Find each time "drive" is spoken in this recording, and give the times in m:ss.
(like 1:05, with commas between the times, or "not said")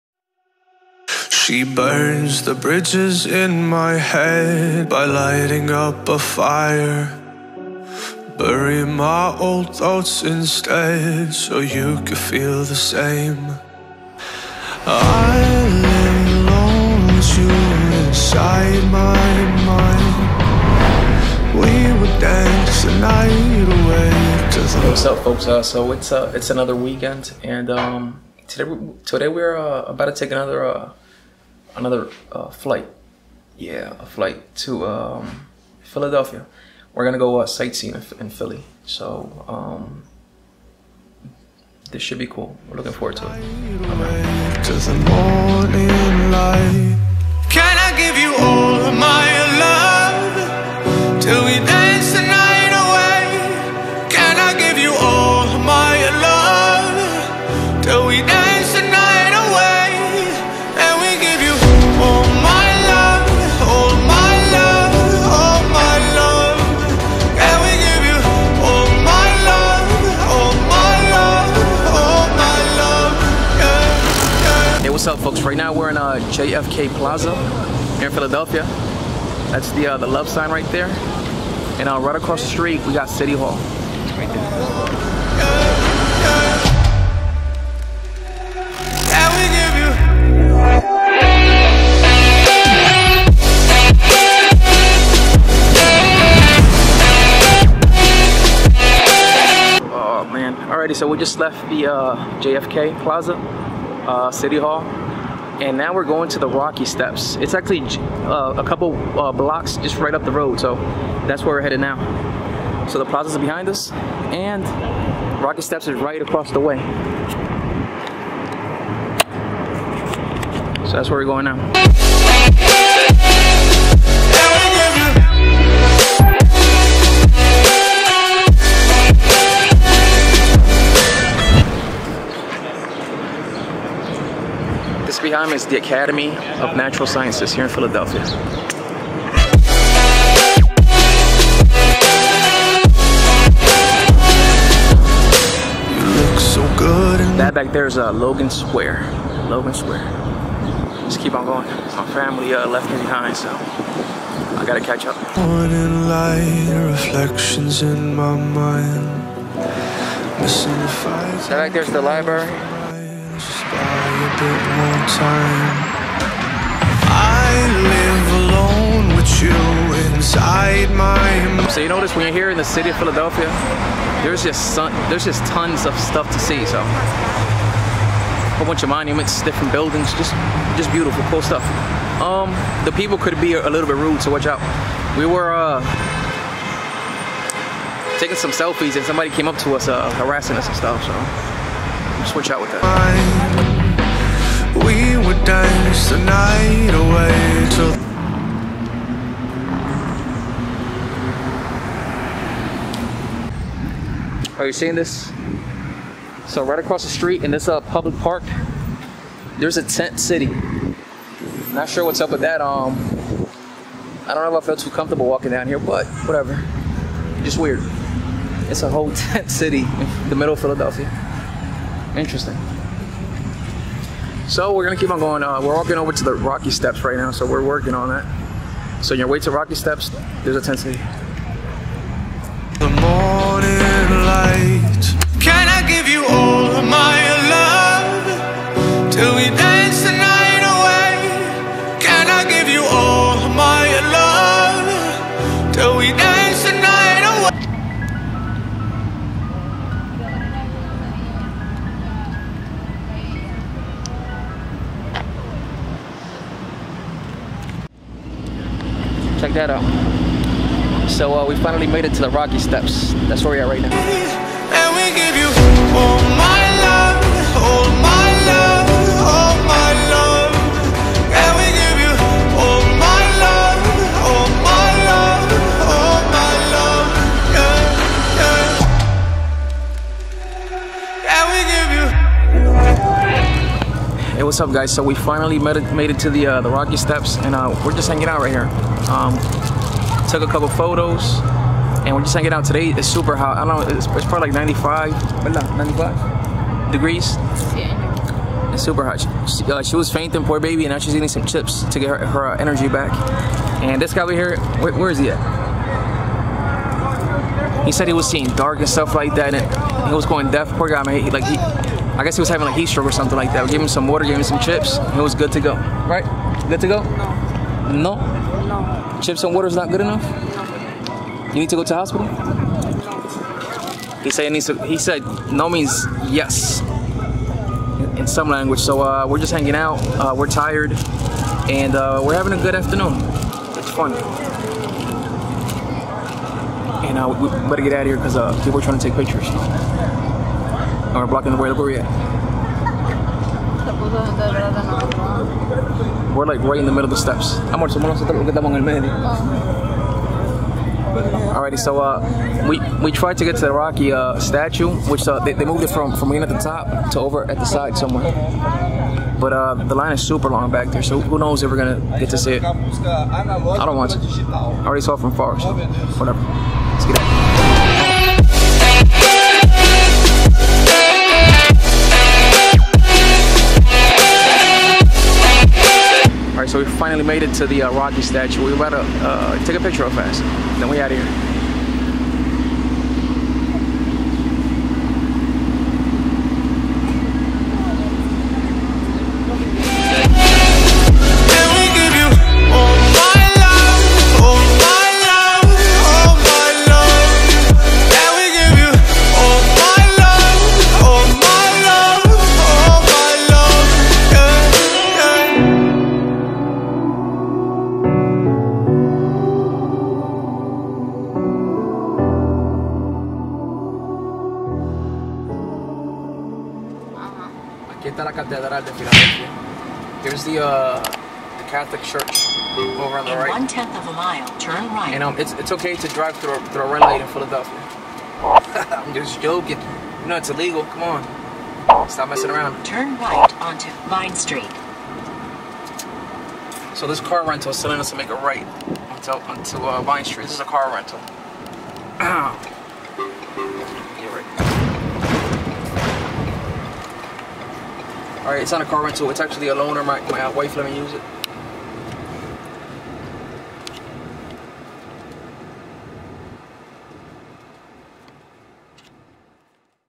7:06.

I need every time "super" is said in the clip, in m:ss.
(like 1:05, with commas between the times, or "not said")
4:53, 4:58, 6:00.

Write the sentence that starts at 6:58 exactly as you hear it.
Aquí está la Catedral de Filadelfia.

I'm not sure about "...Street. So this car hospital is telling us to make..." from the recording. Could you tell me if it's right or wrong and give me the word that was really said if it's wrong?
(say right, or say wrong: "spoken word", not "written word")
wrong: "rental", not "hospital".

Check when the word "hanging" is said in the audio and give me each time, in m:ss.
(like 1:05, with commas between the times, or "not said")
4:48, 4:52, 5:29.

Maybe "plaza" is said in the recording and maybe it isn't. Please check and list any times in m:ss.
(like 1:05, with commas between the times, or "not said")
1:16, 1:43, 1:53.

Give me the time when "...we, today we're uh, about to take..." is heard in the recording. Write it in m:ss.
0:28.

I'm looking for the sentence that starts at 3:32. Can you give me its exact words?
Um, I don't know if I feel too comfortable walking down here, but whatever.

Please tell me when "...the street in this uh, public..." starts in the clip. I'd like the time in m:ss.
3:27.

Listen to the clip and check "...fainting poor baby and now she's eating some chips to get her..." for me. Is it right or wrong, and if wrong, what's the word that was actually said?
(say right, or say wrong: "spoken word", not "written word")
right.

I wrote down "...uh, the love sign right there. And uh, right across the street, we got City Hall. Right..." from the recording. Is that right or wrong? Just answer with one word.
right.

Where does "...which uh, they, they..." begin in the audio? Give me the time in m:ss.
5:55.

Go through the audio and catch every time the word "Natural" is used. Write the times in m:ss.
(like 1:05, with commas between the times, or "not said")
2:16.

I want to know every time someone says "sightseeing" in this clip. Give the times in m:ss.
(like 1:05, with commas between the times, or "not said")
0:37.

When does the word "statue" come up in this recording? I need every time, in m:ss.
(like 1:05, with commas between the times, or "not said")
5:54, 6:18.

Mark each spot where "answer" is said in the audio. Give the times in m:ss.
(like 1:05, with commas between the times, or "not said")
not said.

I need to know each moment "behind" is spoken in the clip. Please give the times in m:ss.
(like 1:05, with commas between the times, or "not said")
1:53, 2:32.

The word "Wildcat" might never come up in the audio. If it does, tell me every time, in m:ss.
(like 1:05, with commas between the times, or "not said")
not said.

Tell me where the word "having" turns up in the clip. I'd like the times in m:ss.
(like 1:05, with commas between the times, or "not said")
5:12, 5:32.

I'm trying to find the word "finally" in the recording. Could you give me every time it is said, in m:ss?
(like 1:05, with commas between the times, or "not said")
4:21, 4:45, 6:16.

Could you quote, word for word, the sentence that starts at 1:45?
And now we're going to the Rocky Steps.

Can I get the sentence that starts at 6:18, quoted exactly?
We better uh, take a picture of us.